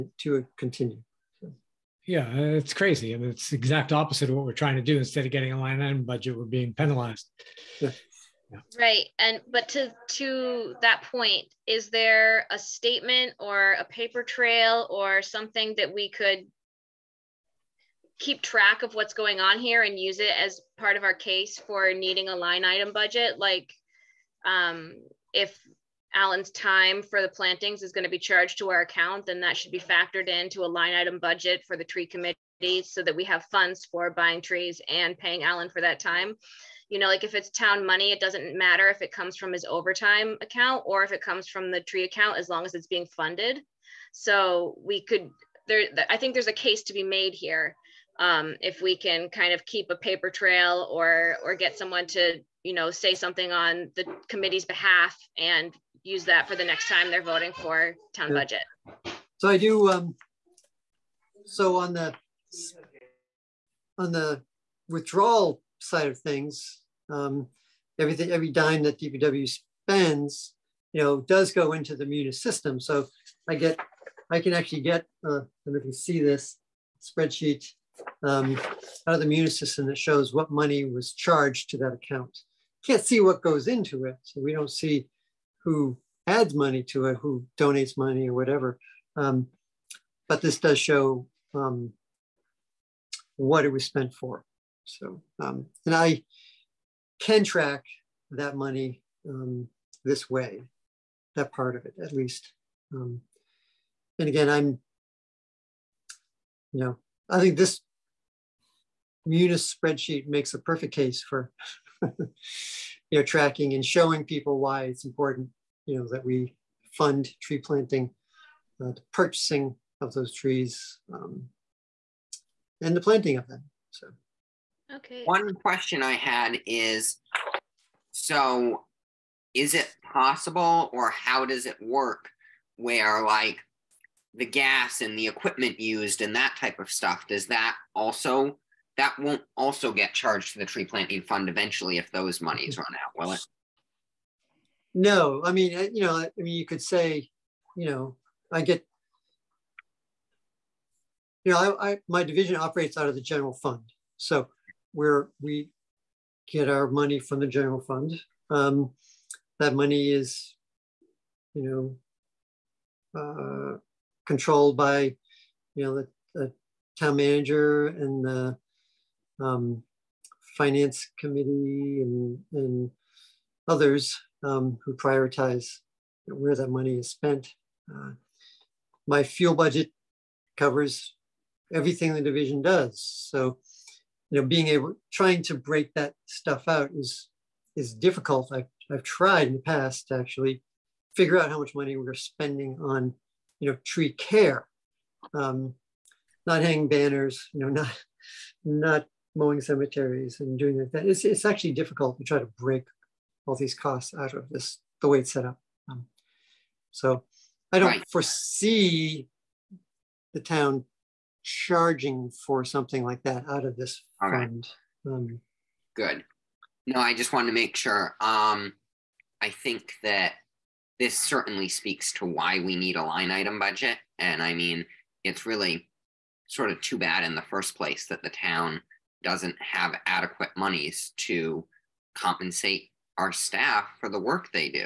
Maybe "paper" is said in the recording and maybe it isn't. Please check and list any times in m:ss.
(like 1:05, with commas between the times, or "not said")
0:13, 0:49.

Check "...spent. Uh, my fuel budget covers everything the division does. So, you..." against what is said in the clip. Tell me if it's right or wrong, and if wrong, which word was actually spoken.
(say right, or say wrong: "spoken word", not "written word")
right.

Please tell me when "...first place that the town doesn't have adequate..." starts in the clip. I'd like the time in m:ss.
3:47.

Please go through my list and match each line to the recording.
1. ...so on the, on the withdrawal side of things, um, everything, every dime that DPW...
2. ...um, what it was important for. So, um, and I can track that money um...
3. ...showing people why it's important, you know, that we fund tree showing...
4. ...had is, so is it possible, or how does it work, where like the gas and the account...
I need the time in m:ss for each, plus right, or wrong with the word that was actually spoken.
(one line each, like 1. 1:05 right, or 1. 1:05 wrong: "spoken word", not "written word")
1. 1:01 right
2. 1:31 wrong: "spent", not "important"
3. 1:53 wrong: "planting", not "showing"
4. 2:06 wrong: "equipment", not "account".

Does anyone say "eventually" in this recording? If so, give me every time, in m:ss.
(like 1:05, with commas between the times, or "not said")
2:21.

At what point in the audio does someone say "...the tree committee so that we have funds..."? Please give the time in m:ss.
0:31.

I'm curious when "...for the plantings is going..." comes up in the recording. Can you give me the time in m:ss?
0:27.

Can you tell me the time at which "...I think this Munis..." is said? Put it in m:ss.
1:47.